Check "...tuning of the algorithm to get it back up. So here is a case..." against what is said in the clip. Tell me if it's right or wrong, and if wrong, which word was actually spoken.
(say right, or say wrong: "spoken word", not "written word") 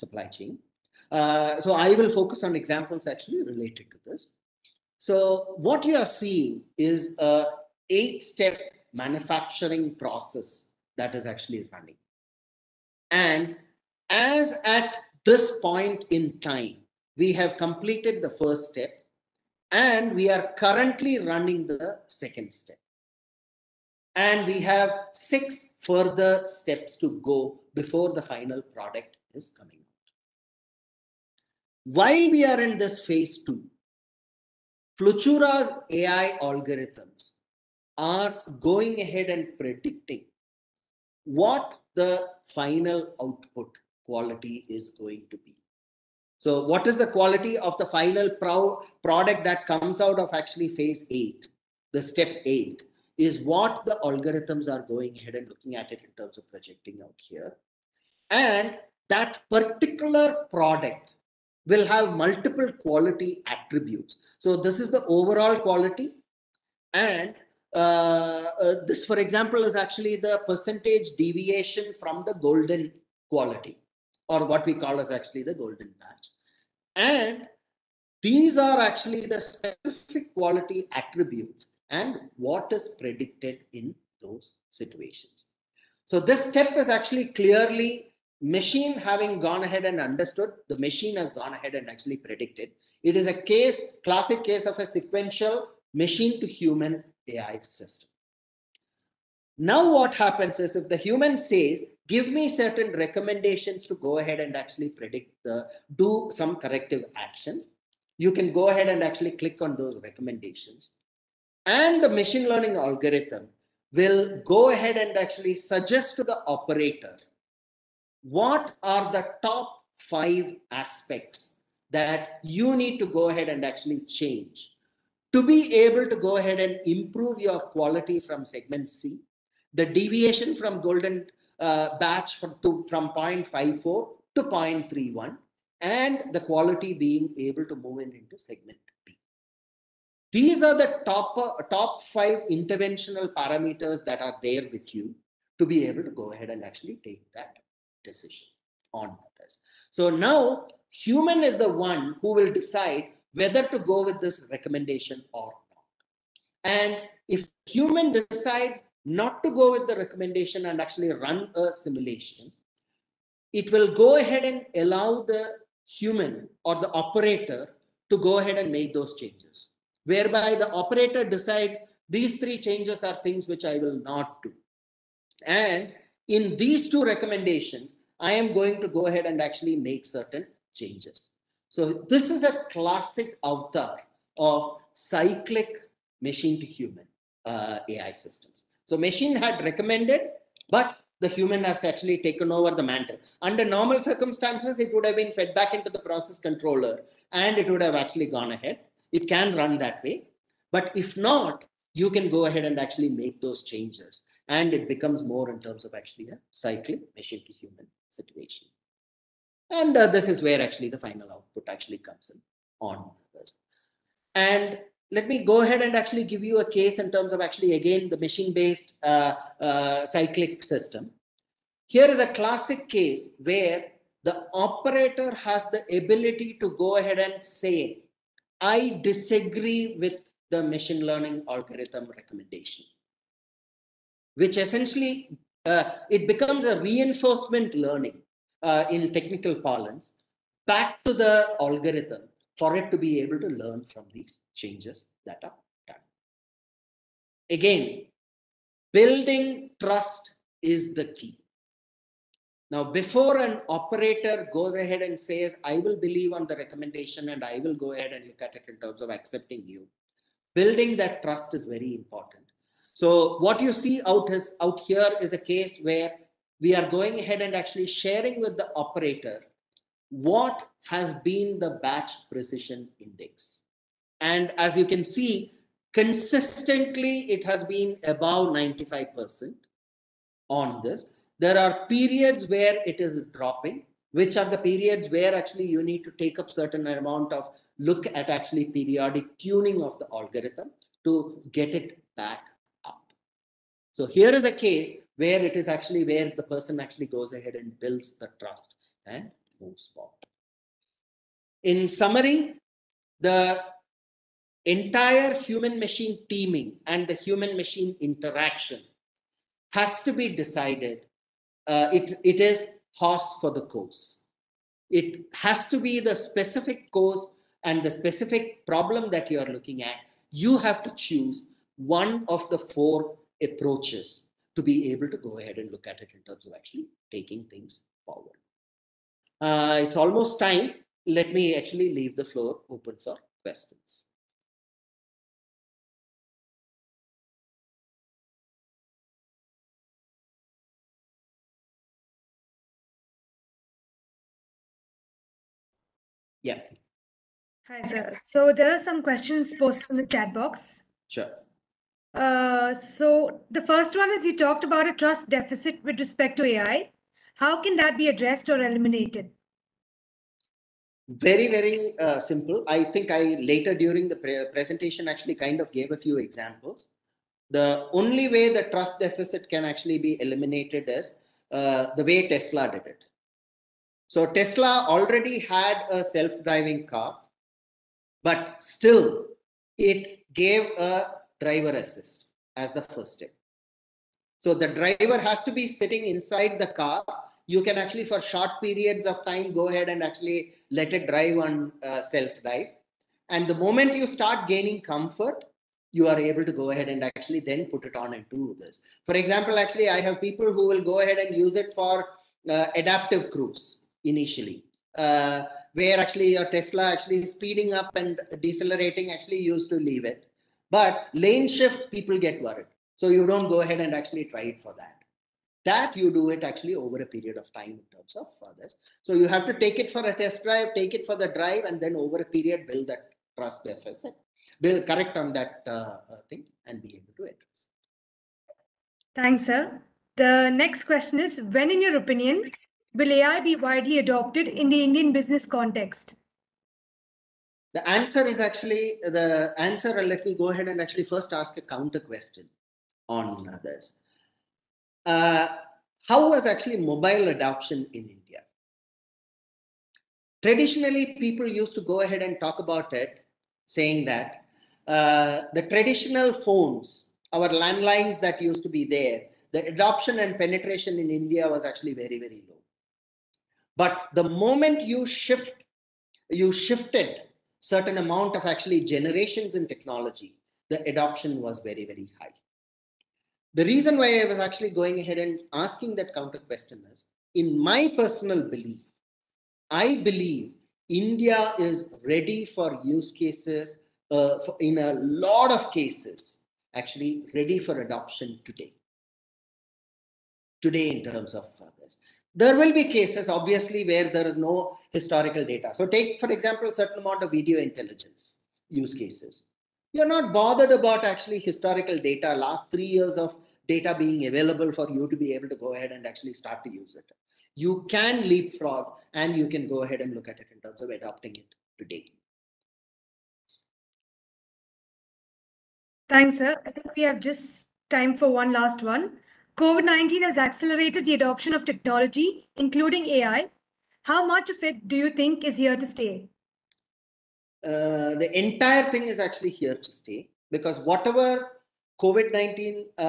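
right.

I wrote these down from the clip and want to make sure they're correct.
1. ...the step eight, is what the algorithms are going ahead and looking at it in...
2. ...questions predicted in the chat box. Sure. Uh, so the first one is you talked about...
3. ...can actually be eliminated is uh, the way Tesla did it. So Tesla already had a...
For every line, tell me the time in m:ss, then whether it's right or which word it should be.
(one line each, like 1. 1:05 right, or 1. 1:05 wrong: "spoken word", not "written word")
1. 0:51 right
2. 5:49 wrong: "posted", not "predicted"
3. 6:09 right.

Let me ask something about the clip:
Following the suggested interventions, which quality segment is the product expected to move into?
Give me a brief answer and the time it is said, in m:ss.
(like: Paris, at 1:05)
segment B, at 2:18.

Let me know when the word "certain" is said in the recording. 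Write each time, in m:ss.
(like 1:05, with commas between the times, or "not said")
1:42, 3:00, 4:46, 7:47, 8:16.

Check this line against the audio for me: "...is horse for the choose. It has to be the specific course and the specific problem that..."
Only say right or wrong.
wrong.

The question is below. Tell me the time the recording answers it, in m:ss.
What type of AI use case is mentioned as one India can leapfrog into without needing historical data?
8:17.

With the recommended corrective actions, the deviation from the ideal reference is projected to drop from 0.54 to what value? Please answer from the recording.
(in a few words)
0.31.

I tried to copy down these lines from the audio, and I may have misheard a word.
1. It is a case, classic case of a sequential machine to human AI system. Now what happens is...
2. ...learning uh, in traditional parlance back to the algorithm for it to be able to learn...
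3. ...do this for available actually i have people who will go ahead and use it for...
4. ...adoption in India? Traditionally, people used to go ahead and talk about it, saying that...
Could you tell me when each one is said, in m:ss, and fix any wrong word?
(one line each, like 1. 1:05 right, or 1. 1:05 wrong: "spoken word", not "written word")
1. 1:33 right
2. 3:57 wrong: "technical", not "traditional"
3. 6:38 wrong: "example", not "available"
4. 7:27 right.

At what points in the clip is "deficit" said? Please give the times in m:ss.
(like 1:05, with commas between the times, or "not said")
5:55, 6:08, 7:03.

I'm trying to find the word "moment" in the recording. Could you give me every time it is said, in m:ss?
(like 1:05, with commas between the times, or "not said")
6:33, 7:44.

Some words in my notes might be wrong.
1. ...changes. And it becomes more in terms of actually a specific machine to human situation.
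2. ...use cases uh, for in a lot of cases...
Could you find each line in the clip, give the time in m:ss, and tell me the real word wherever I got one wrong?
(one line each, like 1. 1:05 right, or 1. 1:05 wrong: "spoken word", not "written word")
1. 3:23 wrong: "cyclic", not "specific"
2. 8:02 right.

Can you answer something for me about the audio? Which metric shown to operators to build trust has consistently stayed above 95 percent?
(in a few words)
batch precision index.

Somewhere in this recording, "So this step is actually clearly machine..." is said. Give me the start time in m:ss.
1:26.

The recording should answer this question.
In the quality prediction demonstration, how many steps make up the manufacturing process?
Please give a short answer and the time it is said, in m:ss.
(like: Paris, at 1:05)
8, at 0:07.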